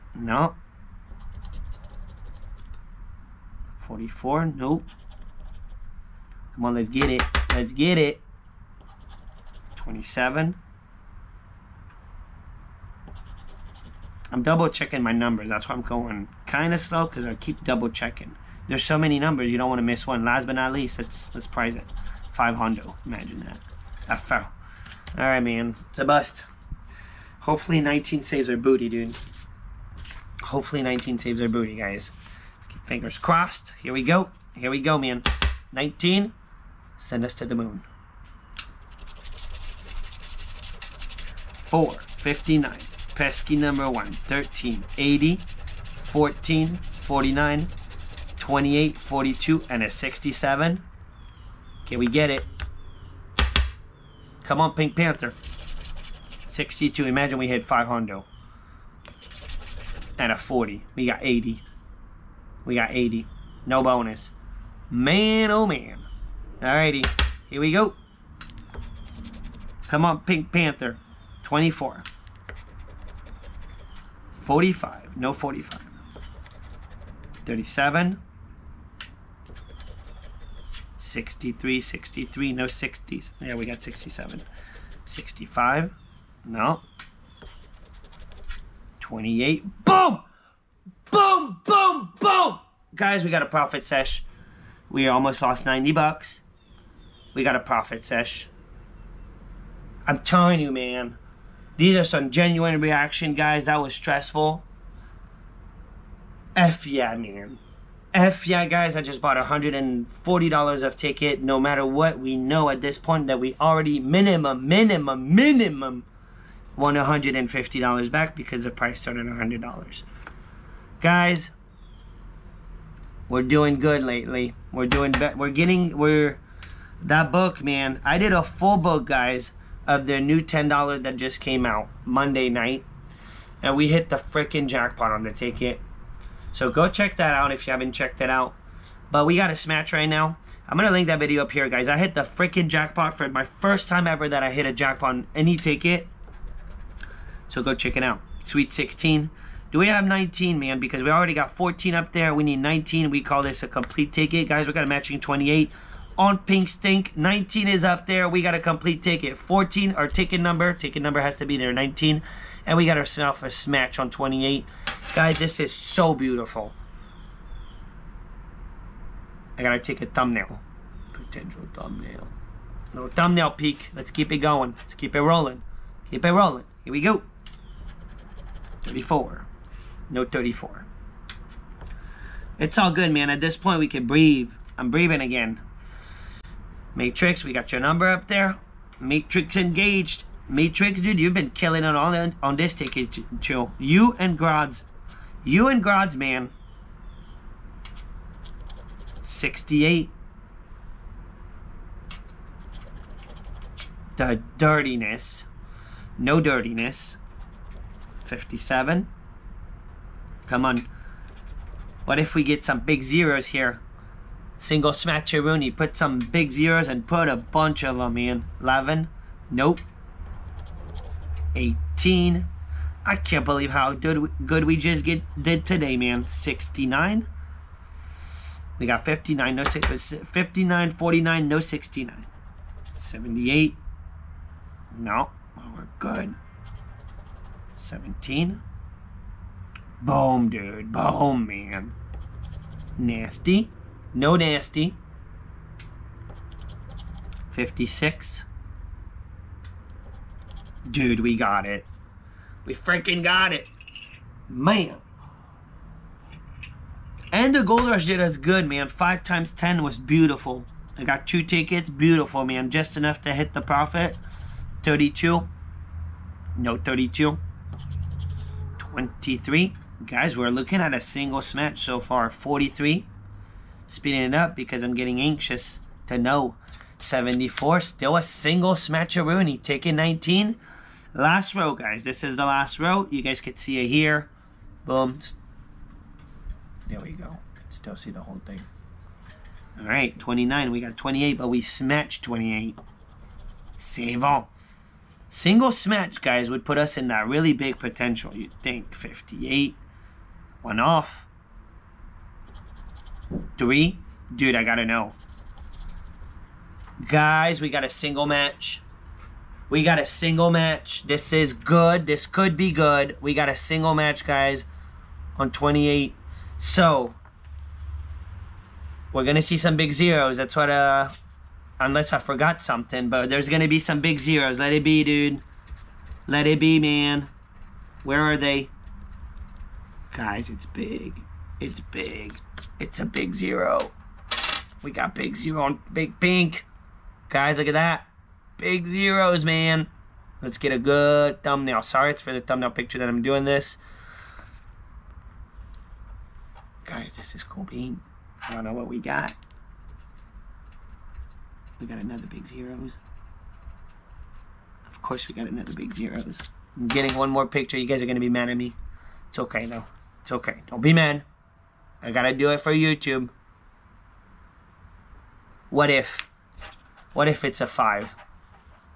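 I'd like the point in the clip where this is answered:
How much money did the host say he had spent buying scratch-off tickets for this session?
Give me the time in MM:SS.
01:49.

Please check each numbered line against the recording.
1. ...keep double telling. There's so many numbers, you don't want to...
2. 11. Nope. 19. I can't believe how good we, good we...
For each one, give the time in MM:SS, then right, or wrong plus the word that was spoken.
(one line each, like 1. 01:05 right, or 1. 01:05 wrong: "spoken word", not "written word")
1. 00:17 wrong: "checking", not "telling"
2. 03:38 wrong: "18", not "19".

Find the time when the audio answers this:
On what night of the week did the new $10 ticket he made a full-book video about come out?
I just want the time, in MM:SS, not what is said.
02:12.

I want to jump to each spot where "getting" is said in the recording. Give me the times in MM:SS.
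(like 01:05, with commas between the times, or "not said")
02:05, 04:34, 05:56.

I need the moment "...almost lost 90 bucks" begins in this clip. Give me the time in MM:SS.
01:35.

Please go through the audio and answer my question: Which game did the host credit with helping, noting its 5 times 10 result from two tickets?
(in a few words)
Gold Rush.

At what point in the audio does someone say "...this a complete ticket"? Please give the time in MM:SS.
02:33.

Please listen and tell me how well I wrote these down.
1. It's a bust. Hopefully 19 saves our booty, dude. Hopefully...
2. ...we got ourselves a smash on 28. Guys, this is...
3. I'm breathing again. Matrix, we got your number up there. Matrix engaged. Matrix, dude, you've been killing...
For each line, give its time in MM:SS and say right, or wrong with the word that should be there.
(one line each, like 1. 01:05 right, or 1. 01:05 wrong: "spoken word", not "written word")
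1. 00:25 right
2. 02:42 right
3. 03:04 right.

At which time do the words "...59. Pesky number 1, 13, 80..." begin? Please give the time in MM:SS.
00:41.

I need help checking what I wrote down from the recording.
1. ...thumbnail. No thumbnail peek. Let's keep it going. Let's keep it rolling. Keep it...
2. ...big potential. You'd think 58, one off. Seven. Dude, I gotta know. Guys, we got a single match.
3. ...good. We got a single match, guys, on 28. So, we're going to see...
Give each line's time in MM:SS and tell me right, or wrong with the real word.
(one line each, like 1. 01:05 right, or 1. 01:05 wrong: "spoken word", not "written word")
1. 02:51 right
2. 04:57 wrong: "Three", not "Seven"
3. 05:12 right.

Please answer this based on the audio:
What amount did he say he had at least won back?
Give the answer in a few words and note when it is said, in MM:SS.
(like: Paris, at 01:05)
$100, at 01:59.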